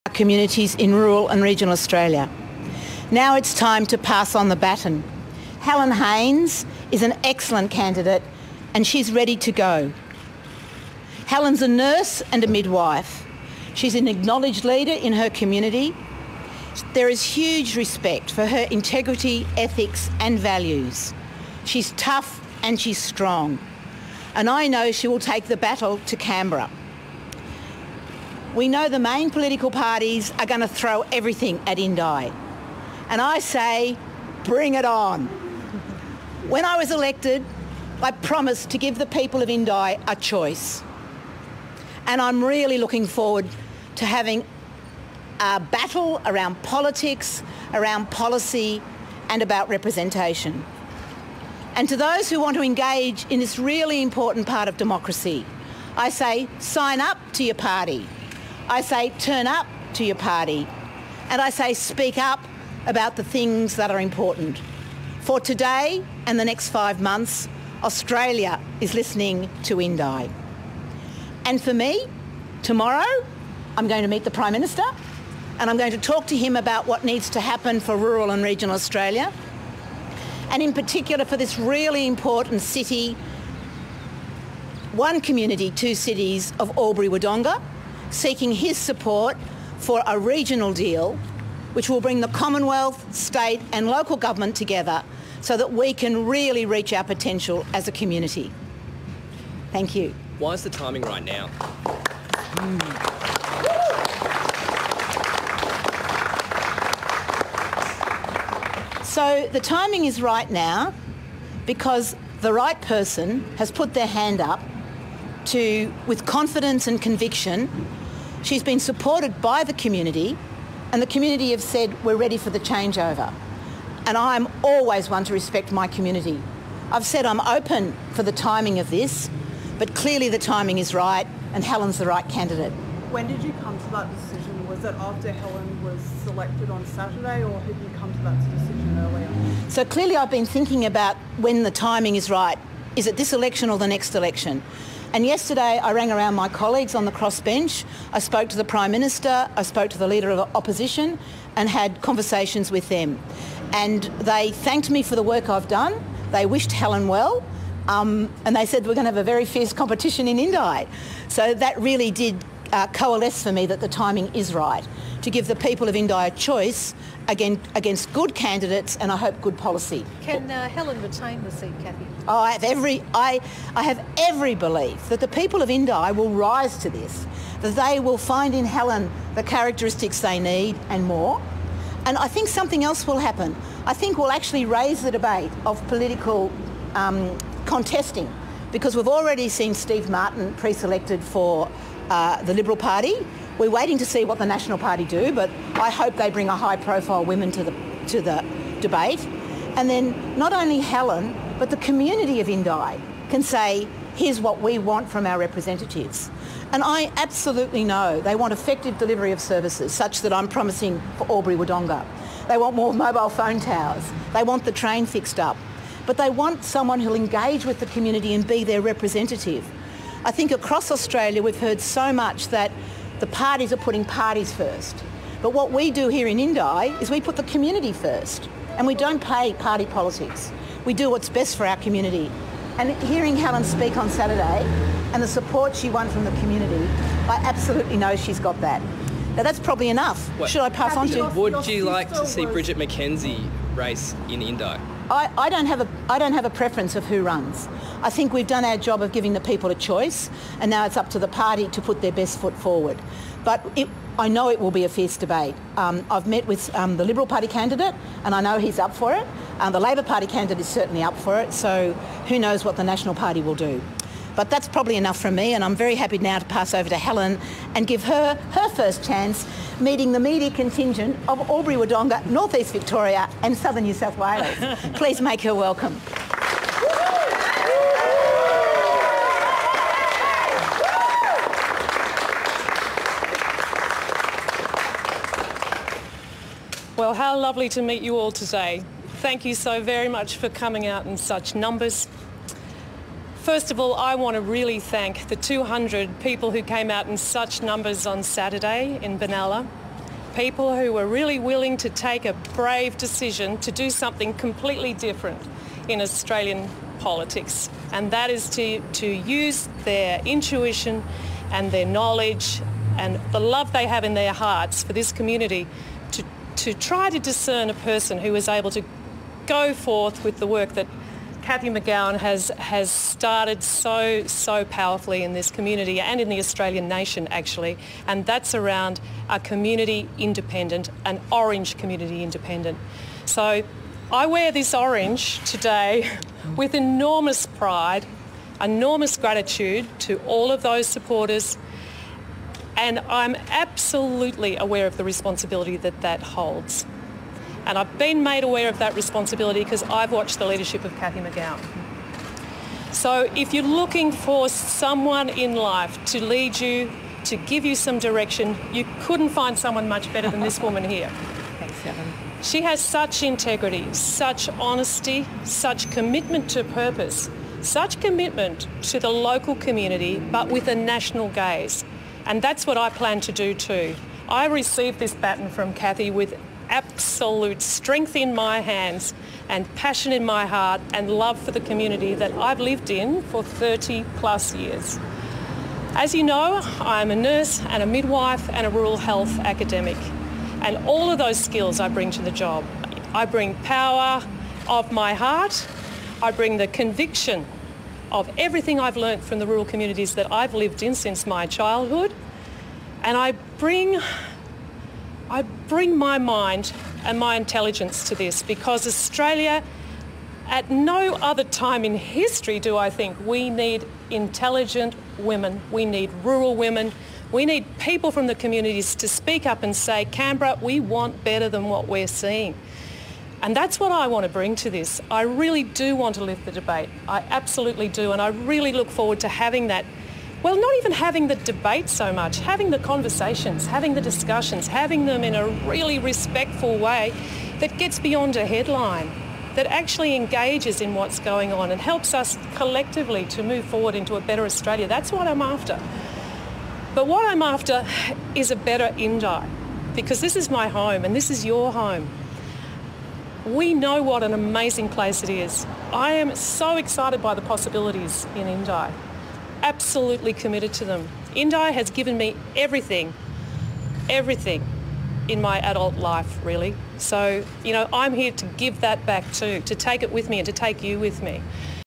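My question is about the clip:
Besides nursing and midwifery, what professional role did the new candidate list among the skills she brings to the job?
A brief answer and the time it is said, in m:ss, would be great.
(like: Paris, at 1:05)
Rural health academic, at 6:28.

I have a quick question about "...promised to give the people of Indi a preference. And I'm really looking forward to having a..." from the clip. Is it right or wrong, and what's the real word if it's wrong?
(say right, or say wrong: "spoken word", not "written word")
wrong: "choice", not "preference".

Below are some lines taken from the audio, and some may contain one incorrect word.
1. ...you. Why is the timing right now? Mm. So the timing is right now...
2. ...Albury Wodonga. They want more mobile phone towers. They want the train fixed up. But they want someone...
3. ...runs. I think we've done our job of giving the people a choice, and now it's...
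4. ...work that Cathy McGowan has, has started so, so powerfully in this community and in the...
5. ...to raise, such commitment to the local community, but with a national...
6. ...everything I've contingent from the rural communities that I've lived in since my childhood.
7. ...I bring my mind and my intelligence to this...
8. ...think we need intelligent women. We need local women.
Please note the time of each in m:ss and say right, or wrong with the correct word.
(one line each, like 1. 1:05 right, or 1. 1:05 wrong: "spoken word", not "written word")
1. 1:39 right
2. 3:31 right
3. 4:07 right
4. 5:20 right
5. 6:06 wrong: "purpose", not "raise"
6. 6:38 wrong: "learnt", not "contingent"
7. 6:45 right
8. 6:52 wrong: "rural", not "local".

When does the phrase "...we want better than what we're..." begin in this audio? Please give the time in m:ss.
7:00.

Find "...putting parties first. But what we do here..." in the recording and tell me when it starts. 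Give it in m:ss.
3:43.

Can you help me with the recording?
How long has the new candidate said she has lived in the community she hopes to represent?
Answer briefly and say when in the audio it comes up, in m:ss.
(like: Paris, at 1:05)
30 plus years, at 6:23.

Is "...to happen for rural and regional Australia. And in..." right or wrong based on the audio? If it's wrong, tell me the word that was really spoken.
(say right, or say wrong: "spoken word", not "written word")
right.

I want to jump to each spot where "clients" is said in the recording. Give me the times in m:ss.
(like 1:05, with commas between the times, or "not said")
not said.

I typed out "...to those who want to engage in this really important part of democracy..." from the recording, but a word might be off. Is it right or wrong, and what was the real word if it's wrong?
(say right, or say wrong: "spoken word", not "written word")
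right.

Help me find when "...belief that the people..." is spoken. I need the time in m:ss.
2:54.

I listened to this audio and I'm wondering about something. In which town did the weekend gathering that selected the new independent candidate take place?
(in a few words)
Benalla.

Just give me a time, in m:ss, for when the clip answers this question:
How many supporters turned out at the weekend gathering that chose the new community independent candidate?
4:55.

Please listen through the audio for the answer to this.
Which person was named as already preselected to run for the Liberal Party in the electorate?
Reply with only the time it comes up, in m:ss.
3:09.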